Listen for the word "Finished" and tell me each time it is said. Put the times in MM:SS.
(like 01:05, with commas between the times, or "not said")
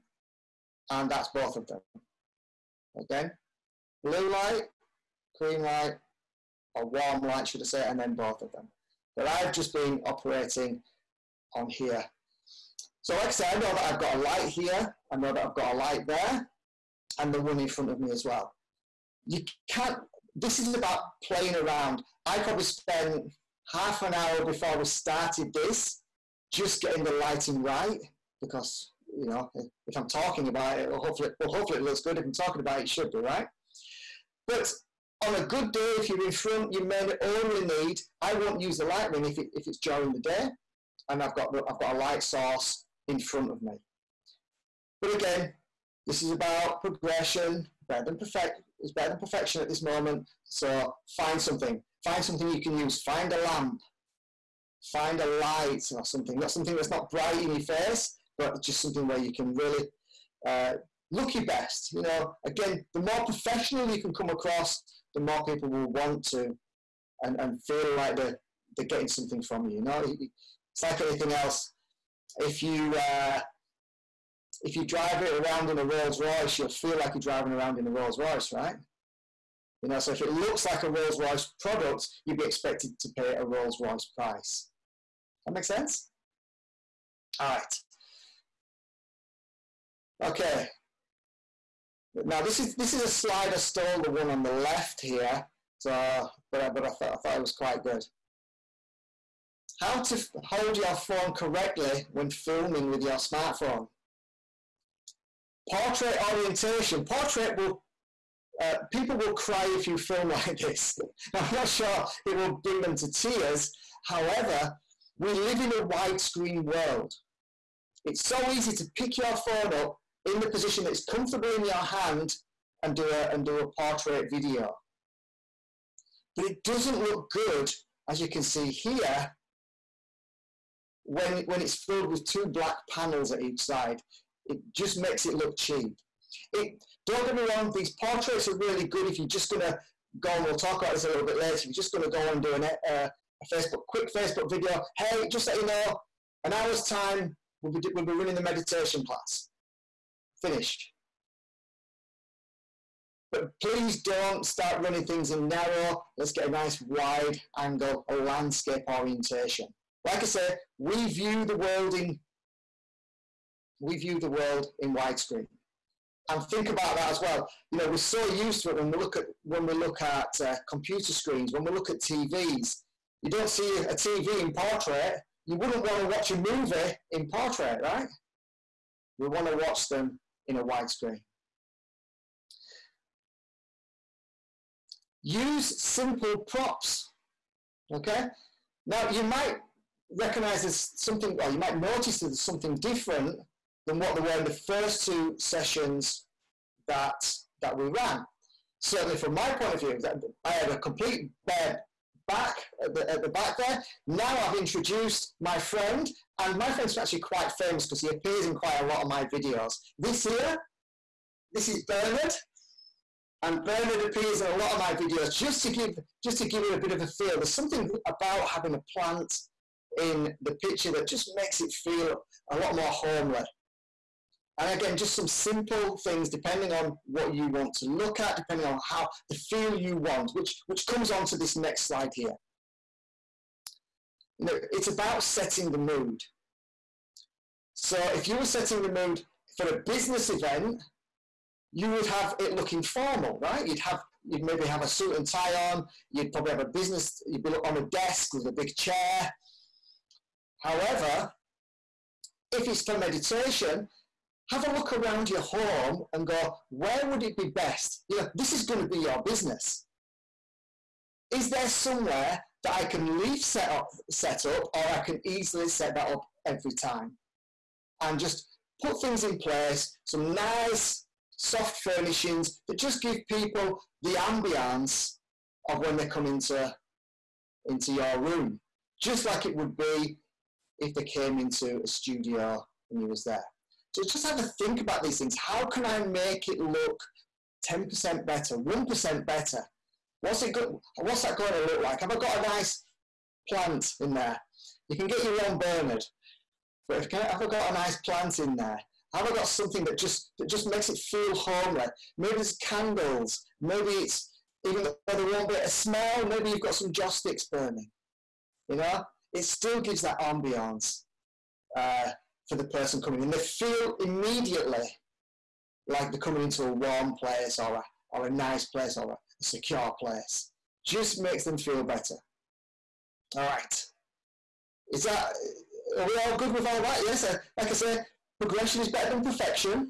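02:30.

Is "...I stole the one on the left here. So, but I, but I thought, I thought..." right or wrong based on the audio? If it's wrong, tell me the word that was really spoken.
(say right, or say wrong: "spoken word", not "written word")
right.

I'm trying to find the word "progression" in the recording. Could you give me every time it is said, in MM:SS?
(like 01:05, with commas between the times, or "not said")
00:46, 05:28.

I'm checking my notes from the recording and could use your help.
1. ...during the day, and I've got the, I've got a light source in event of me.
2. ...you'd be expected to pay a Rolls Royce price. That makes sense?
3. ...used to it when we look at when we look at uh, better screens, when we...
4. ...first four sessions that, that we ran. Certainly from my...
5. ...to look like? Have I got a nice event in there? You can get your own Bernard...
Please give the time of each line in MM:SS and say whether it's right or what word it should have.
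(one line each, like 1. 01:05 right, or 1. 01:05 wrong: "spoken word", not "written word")
1. 00:39 wrong: "front", not "event"
2. 01:22 right
3. 02:48 wrong: "computer", not "better"
4. 03:14 wrong: "two", not "four"
5. 04:51 wrong: "plant", not "event".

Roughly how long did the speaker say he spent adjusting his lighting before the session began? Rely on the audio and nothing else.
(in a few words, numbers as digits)
half an hour.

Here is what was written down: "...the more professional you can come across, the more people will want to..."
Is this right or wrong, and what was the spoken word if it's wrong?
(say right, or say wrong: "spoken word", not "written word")
right.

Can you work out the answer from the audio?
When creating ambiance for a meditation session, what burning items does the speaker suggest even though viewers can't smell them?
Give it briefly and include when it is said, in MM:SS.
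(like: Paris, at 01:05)
joss sticks, at 05:06.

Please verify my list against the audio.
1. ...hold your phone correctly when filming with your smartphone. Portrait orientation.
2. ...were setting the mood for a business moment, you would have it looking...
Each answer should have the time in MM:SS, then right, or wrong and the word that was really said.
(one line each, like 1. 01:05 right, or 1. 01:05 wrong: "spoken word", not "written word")
1. 01:40 right
2. 03:58 wrong: "event", not "moment".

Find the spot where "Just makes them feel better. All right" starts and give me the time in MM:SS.
05:20.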